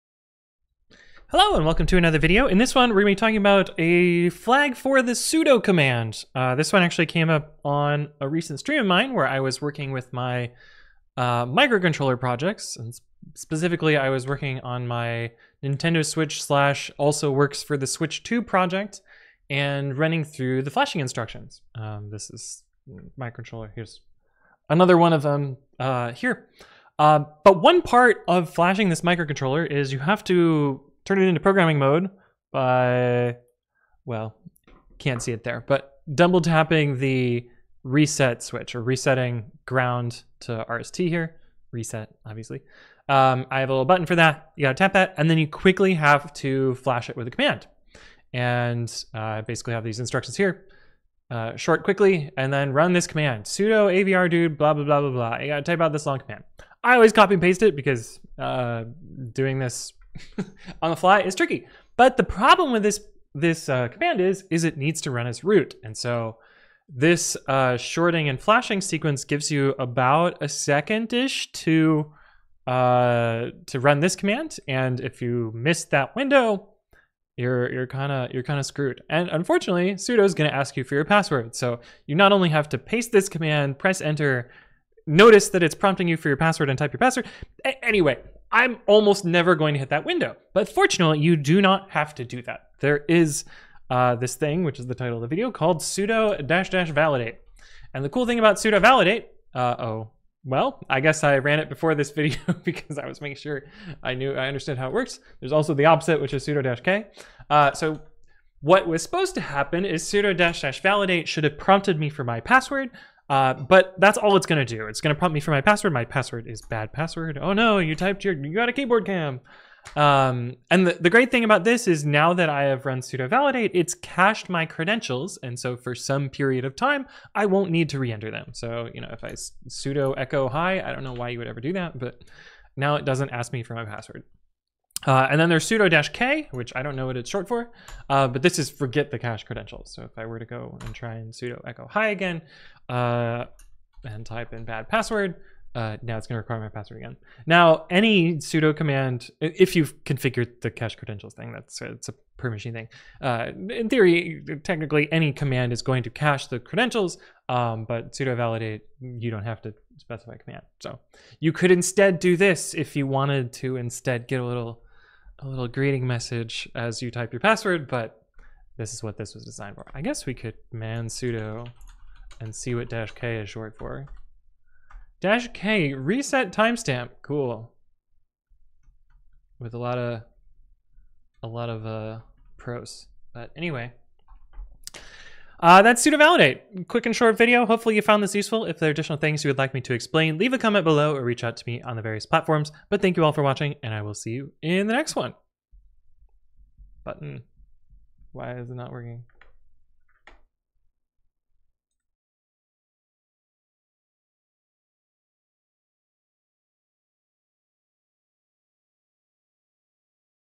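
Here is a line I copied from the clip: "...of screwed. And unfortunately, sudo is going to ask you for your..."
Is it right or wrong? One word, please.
right.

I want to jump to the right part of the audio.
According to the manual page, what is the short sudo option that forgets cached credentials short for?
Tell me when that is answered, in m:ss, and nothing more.
2:55.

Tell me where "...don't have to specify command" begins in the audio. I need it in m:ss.
2:39.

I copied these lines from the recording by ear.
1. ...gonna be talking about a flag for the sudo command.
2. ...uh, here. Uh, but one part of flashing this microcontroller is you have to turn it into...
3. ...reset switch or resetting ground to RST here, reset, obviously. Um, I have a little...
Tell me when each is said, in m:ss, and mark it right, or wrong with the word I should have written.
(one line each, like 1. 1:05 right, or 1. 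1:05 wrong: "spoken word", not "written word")
1. 0:03 right
2. 0:25 right
3. 0:37 right.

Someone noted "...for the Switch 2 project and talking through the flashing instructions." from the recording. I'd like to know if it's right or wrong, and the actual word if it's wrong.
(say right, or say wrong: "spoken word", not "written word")
wrong: "running", not "talking".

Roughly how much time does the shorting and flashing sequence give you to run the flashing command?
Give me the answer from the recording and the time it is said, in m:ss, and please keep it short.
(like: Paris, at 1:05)
About a second, at 1:09.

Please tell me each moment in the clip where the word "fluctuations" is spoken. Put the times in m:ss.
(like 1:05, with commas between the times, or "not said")
not said.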